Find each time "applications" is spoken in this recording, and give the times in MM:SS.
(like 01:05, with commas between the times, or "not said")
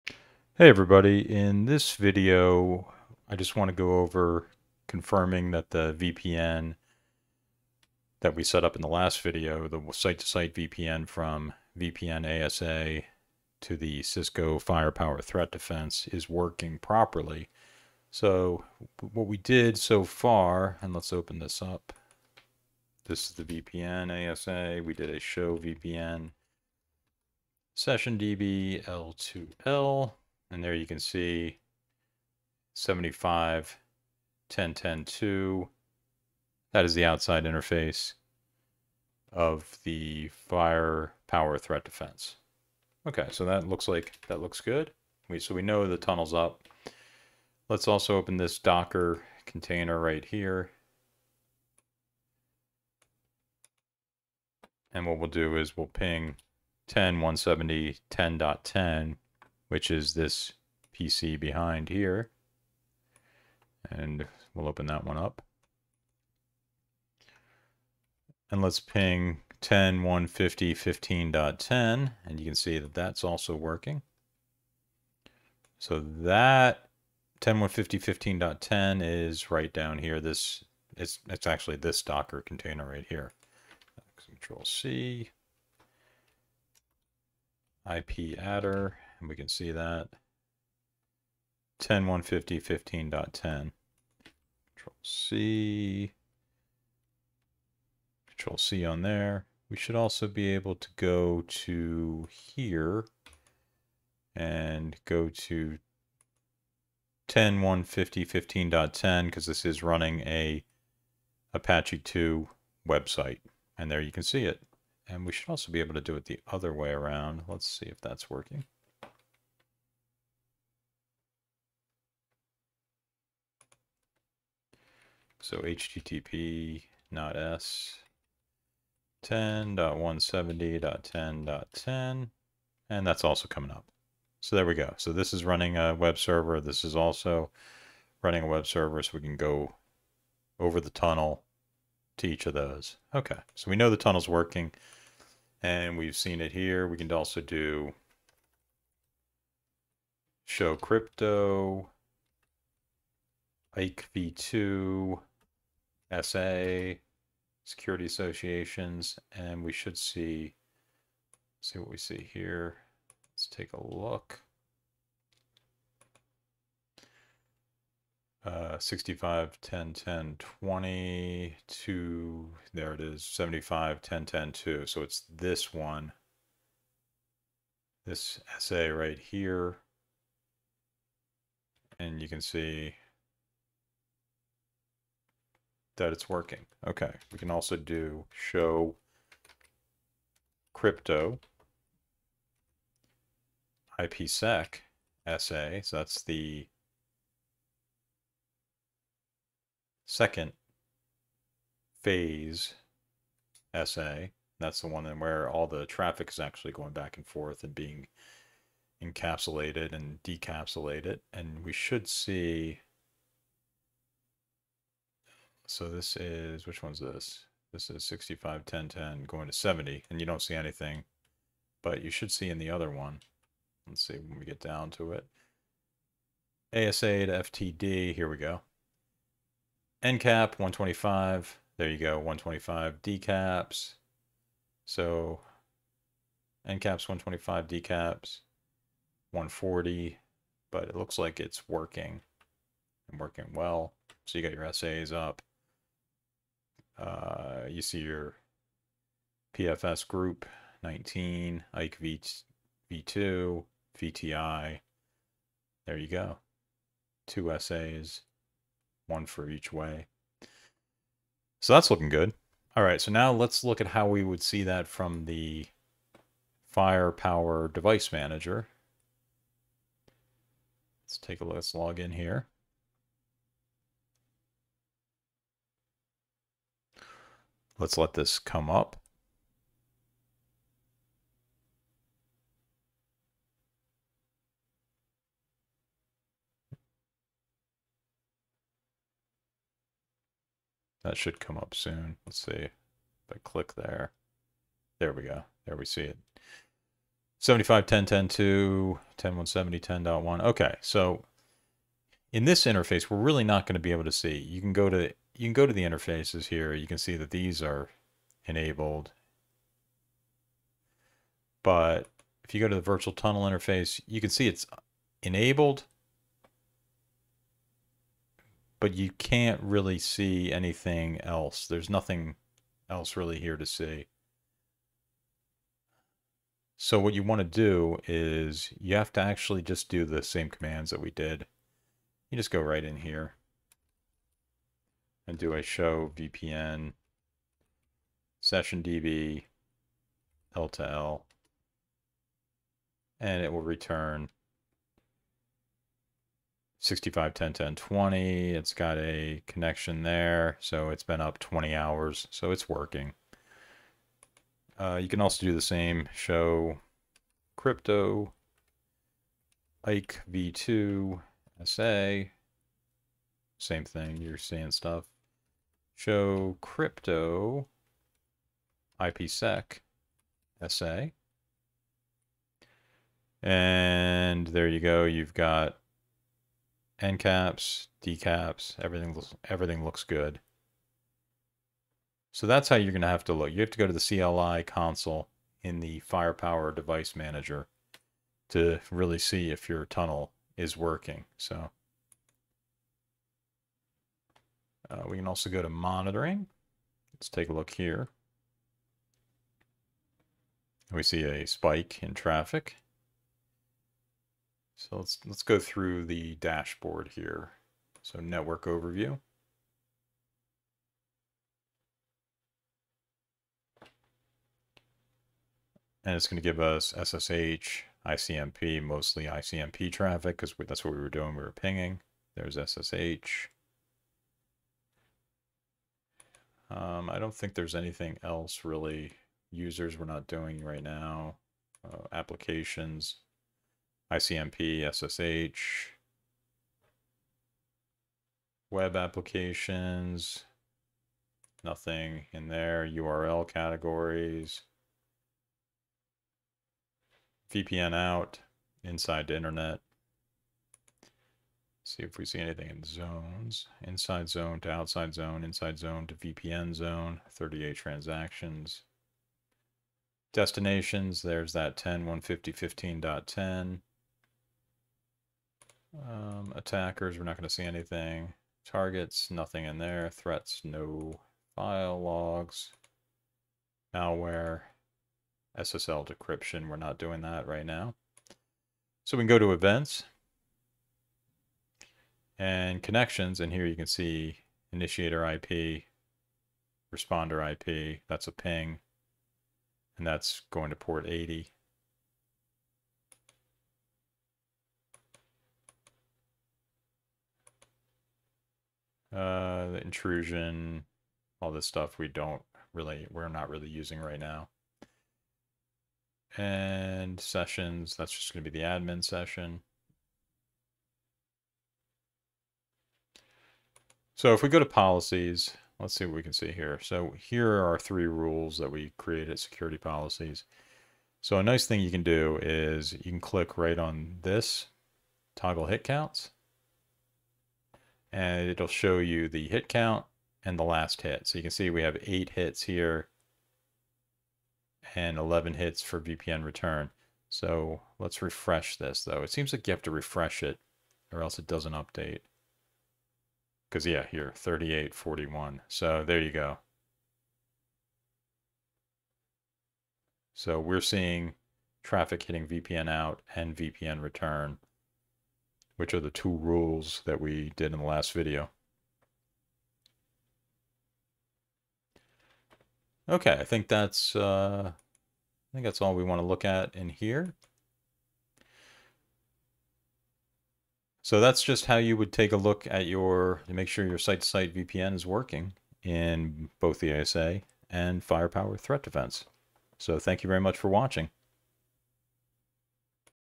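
07:12, 07:18.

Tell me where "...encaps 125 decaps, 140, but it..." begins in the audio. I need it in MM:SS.
03:56.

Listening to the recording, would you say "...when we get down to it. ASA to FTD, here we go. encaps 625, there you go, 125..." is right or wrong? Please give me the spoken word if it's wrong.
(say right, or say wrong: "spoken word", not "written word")
wrong: "125", not "625".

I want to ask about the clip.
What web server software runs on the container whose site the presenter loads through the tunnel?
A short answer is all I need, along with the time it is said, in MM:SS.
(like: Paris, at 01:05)
Apache 2, at 01:51.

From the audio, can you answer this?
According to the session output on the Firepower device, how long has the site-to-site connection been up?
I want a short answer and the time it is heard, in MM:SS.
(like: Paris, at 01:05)
20 hours, at 05:51.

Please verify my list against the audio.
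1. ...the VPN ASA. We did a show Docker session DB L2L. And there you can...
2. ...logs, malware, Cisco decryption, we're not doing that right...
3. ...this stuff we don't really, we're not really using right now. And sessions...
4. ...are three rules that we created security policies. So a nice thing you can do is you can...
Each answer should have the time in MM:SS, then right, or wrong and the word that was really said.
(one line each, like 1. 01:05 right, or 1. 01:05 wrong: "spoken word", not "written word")
1. 00:23 wrong: "VPN", not "Docker"
2. 07:52 wrong: "SSL", not "Cisco"
3. 08:21 right
4. 08:37 right.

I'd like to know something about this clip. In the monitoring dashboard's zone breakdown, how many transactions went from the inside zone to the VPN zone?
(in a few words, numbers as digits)
38.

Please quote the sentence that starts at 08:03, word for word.
And here you can see initiator IP, responder IP, that's a ping, and that's going to port 80.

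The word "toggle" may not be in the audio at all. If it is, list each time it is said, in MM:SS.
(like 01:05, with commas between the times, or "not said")
08:45.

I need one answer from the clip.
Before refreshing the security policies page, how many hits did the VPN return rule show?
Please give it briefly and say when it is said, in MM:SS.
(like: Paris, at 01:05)
11, at 08:55.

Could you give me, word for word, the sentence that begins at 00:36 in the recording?
That is the outside interface of the fire power threat defense.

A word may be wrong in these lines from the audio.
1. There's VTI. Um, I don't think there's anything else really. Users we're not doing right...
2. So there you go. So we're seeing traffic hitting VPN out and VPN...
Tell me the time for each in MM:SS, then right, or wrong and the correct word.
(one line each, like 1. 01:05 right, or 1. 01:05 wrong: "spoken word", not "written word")
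1. 07:02 wrong: "SSH", not "VTI"
2. 09:05 right.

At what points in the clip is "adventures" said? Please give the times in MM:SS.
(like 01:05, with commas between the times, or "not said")
not said.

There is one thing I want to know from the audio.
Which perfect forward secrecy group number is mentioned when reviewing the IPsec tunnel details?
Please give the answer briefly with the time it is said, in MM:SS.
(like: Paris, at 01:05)
19, at 04:09.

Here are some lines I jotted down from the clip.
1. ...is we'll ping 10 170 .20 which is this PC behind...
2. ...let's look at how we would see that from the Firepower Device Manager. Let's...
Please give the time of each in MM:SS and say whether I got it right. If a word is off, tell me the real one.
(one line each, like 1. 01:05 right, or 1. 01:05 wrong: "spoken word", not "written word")
1. 00:55 wrong: "10", not "20"
2. 04:23 right.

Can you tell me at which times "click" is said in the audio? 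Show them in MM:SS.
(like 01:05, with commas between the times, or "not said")
04:53, 08:43.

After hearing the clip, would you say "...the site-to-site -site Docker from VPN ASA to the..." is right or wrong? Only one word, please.
wrong.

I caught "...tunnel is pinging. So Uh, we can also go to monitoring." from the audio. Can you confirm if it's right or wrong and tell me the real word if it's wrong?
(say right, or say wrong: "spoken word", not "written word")
wrong: "working", not "pinging".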